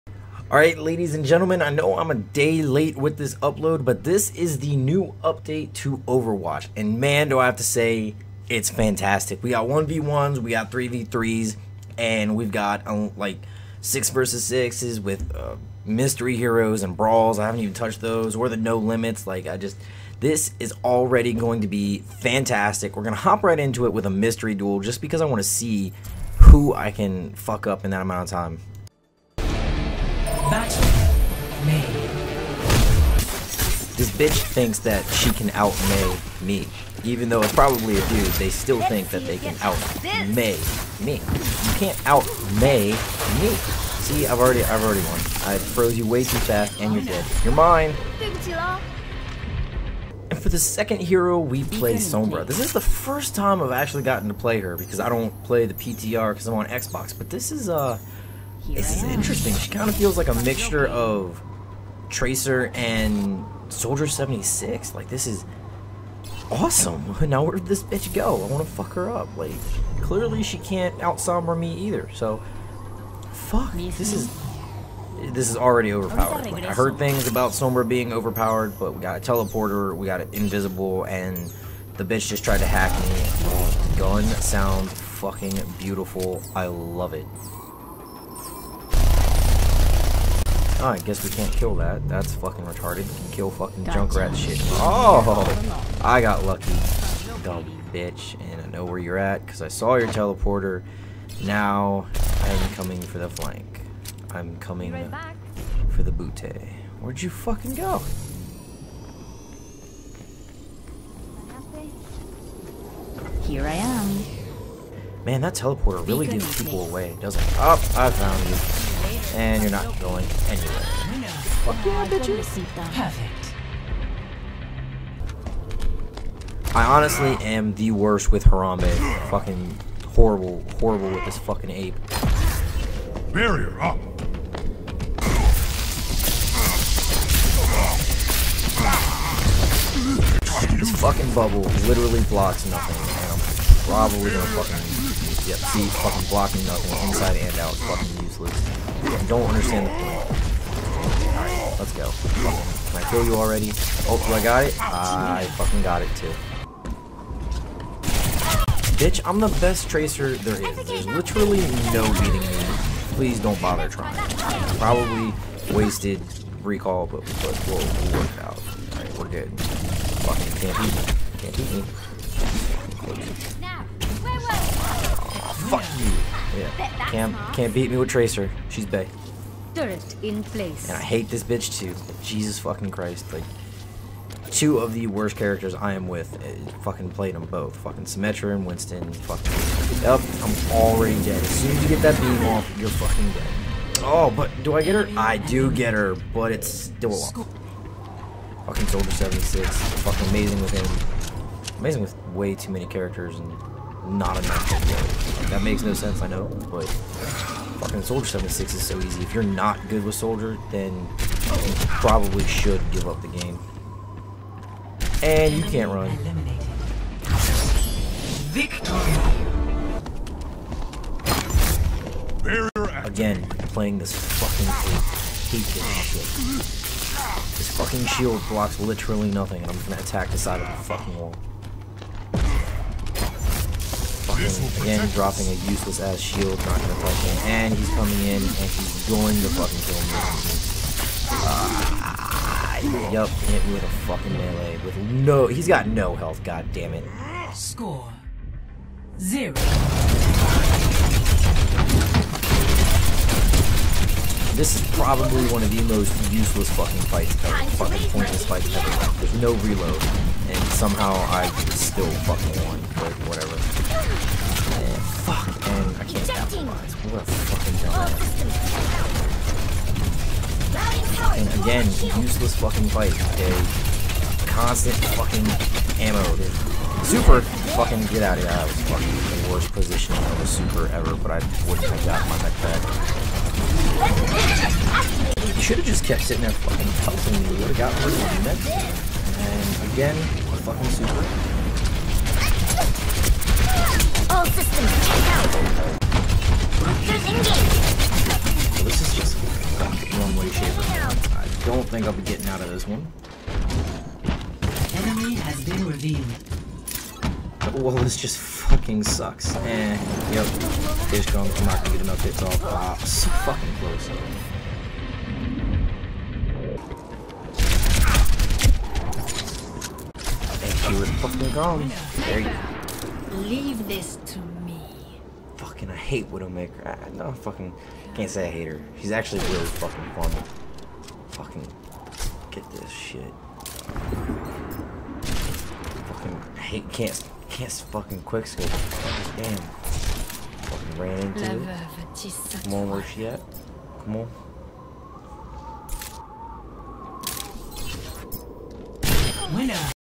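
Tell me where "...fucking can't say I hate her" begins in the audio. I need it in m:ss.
5:27.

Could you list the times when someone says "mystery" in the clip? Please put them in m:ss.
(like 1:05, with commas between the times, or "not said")
0:15, 0:24.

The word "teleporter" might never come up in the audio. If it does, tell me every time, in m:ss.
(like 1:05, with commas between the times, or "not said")
1:19, 1:40, 1:55.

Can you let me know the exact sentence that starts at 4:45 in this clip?
You should have just kept sitting there fucking pelting me.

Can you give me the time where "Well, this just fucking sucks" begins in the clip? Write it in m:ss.
5:07.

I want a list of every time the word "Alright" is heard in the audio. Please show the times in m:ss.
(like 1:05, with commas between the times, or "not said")
0:00, 2:31, 2:48.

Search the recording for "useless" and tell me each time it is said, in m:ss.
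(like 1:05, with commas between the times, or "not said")
2:28, 3:55, 4:16, 4:32.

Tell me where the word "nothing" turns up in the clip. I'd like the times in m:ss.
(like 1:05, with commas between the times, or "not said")
2:22, 2:26, 3:49.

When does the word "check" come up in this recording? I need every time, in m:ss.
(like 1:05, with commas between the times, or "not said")
4:55.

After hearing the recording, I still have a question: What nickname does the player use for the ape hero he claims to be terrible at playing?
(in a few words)
Harambe.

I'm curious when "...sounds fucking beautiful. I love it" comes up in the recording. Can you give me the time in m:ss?
1:24.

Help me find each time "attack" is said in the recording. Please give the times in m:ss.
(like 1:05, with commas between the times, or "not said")
3:50.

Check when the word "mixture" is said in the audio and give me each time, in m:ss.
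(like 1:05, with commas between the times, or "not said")
1:00.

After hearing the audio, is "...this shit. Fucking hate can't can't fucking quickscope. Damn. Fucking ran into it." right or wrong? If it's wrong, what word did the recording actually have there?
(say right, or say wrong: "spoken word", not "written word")
right.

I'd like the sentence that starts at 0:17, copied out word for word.
I haven't even touched those, or the no limits.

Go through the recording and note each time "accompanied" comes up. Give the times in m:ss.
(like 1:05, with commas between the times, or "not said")
not said.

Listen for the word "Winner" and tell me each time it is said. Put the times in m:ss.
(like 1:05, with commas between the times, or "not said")
5:49.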